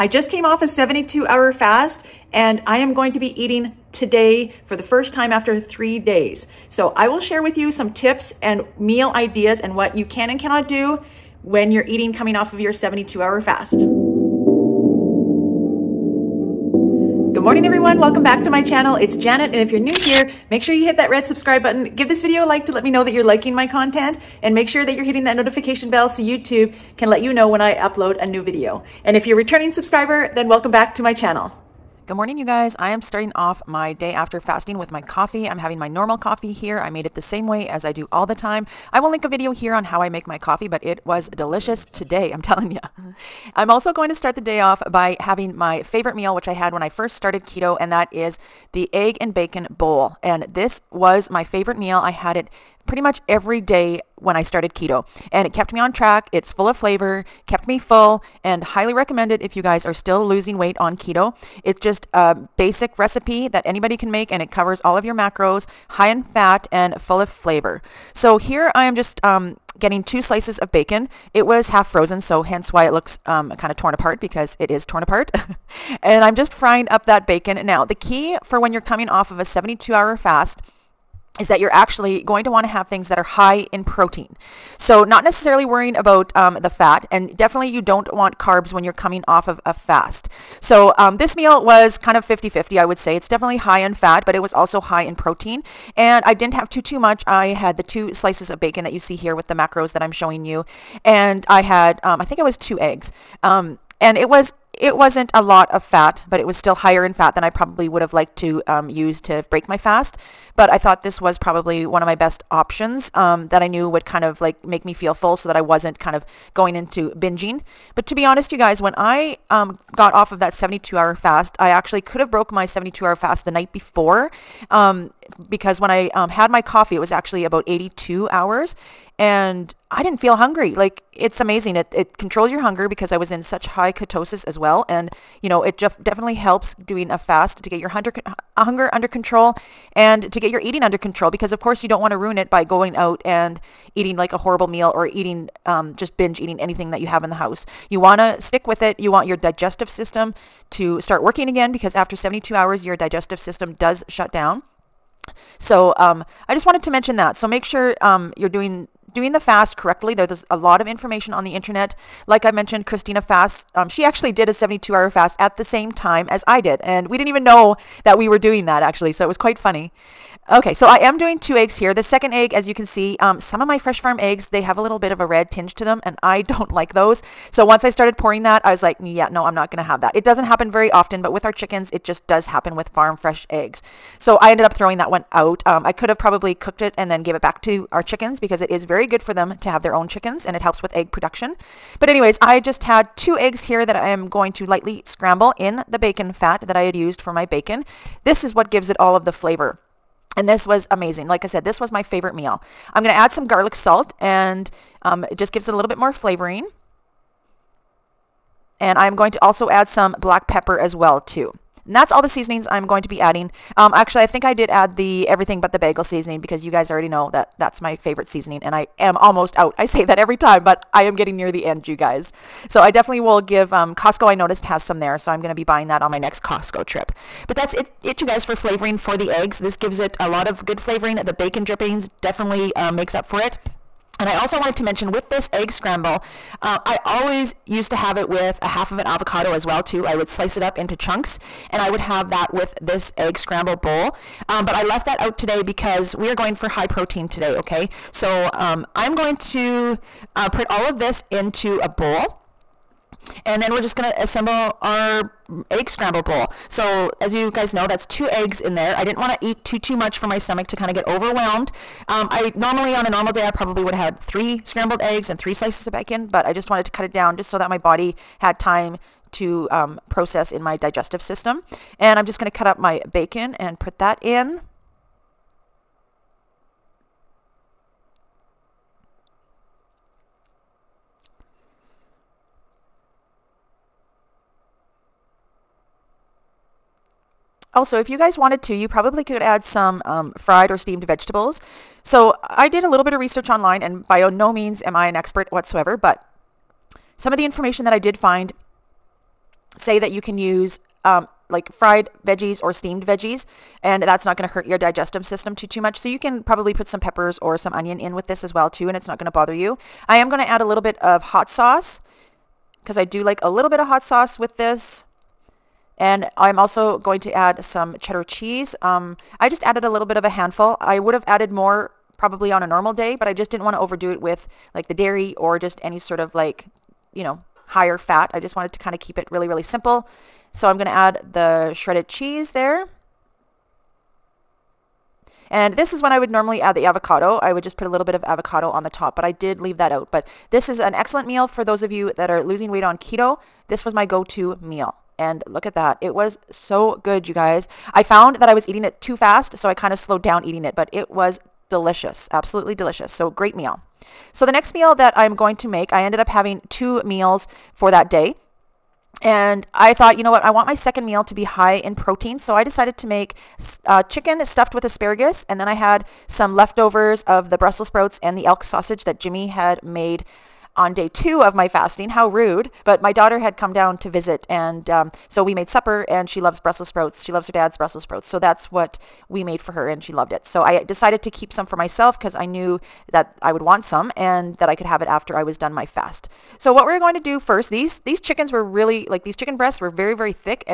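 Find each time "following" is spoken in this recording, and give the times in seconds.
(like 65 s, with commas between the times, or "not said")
not said.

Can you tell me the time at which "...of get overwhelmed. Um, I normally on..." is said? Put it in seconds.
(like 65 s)
260 s.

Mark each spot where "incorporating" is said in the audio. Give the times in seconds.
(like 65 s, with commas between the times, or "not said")
not said.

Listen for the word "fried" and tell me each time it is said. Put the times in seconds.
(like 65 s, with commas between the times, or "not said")
290 s, 301 s.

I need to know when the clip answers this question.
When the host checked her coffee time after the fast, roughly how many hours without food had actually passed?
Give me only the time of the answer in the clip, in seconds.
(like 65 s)
127 s.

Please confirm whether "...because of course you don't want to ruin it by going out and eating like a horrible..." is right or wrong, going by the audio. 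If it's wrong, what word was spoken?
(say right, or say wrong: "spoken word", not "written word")
right.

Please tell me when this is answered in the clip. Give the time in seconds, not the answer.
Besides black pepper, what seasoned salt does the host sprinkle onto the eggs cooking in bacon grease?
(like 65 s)
203 s.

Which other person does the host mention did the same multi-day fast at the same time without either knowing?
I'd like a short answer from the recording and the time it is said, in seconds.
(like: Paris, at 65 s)
Christina Fast, at 162 s.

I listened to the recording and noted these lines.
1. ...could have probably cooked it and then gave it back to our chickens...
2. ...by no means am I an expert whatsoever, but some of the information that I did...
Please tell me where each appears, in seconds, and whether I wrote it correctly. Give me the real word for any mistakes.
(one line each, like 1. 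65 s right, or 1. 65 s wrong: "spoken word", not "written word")
1. 185 s right
2. 294 s right.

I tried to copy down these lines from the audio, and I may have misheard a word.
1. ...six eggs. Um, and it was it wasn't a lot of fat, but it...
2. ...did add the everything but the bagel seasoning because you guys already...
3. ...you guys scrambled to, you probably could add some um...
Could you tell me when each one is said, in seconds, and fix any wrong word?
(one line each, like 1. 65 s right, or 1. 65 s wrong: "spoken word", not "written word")
1. 102 s wrong: "two", not "six"
2. 214 s right
3. 288 s wrong: "wanted", not "scrambled".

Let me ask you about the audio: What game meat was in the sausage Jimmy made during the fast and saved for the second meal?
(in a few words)
elk.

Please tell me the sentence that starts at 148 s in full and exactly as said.
You want your digestive system to start working again because after 72 hours, your digestive system does shut down.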